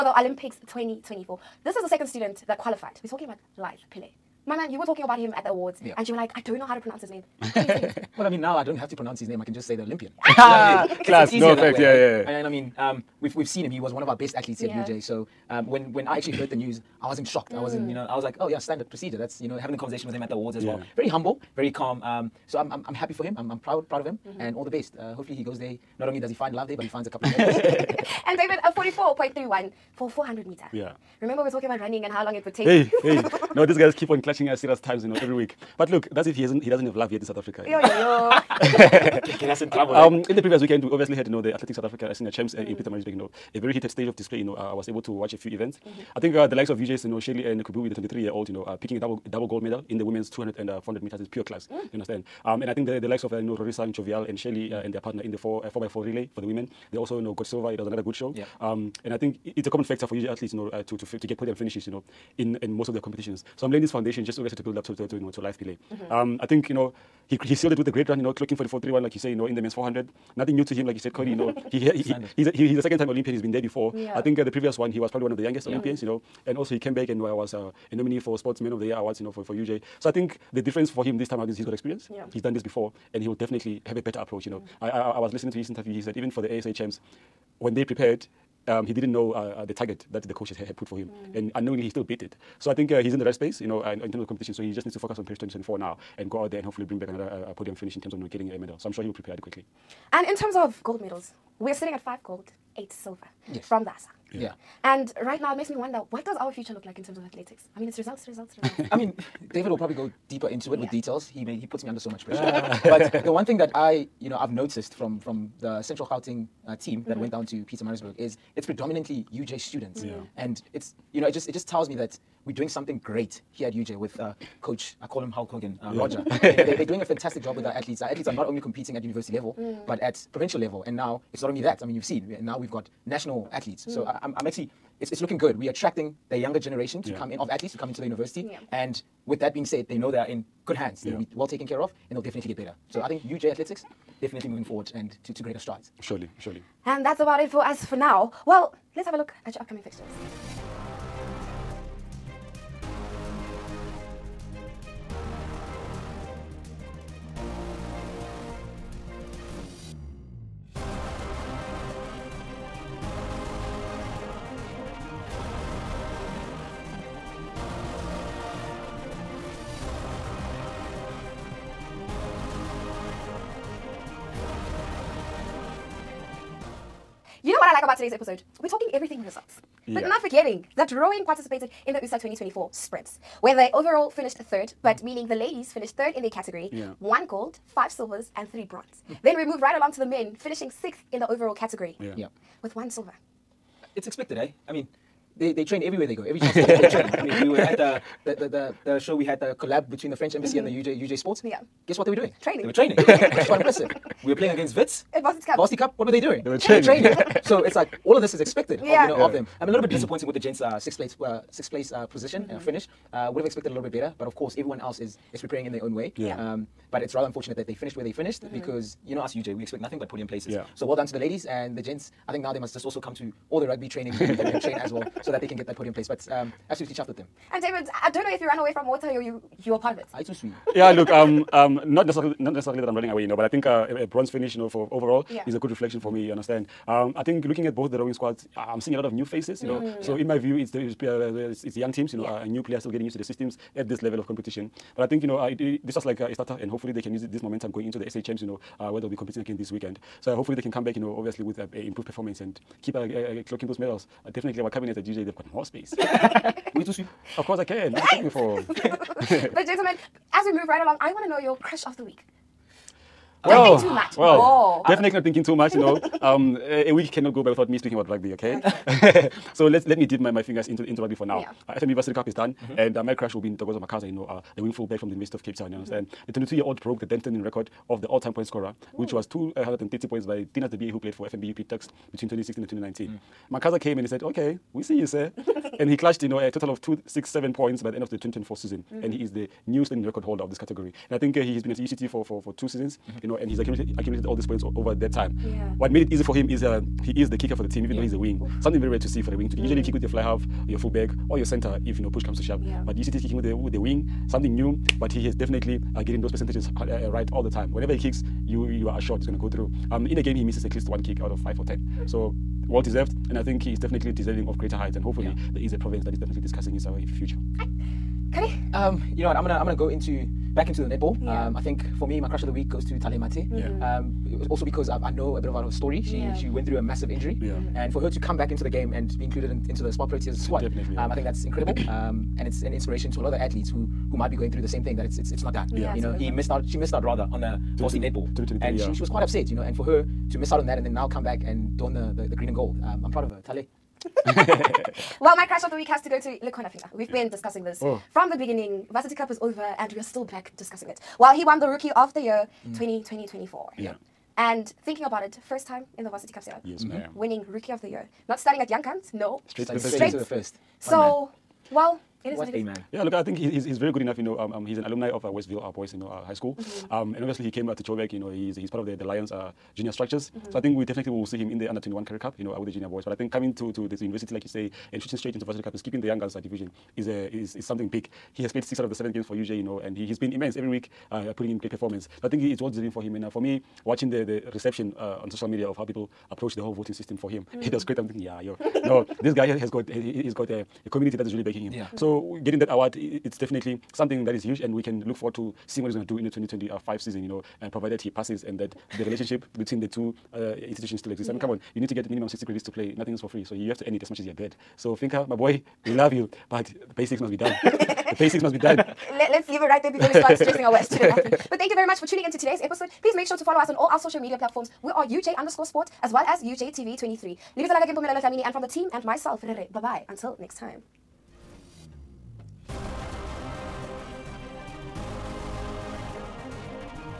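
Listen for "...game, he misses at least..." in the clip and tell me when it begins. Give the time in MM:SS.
05:10.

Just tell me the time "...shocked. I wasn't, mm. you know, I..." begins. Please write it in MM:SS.
00:17.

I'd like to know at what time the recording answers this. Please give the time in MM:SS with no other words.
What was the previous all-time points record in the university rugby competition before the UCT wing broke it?
04:39.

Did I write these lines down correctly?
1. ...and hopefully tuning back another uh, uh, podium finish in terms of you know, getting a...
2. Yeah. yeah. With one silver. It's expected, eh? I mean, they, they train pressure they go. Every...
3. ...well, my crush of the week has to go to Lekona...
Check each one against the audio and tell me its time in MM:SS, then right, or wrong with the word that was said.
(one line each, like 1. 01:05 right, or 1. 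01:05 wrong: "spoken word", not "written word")
1. 01:36 wrong: "bring", not "tuning"
2. 03:11 wrong: "everywhere", not "pressure"
3. 05:45 right.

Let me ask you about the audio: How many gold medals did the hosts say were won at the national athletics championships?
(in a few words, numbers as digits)
5.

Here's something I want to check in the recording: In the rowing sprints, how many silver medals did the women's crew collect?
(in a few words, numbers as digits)
5.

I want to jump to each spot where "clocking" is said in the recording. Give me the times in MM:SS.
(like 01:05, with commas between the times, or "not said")
01:08, 04:13.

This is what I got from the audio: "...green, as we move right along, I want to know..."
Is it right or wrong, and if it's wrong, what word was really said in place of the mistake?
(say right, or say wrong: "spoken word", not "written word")
wrong: "gentlemen", not "green".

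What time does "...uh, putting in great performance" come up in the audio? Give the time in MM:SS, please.
06:21.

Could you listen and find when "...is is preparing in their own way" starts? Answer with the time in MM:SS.
03:34.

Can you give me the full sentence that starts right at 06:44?
So, Finka, my boy, we love you, but the basics must be done.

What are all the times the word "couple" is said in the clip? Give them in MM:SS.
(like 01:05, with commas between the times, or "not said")
00:27.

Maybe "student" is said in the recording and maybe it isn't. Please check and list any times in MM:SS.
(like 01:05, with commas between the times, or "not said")
00:02, 01:59, 06:50.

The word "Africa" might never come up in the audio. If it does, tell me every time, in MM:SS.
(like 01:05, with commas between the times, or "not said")
00:37, 00:41.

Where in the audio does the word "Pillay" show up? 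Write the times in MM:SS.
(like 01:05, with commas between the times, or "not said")
00:03, 01:05.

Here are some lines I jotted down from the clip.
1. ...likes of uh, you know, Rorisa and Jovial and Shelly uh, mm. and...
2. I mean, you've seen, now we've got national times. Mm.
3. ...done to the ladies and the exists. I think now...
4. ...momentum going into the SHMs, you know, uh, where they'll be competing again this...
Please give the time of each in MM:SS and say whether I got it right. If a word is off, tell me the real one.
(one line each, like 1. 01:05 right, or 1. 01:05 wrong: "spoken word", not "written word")
1. 00:53 right
2. 02:11 wrong: "athletes", not "times"
3. 03:40 wrong: "gents", not "exists"
4. 04:07 right.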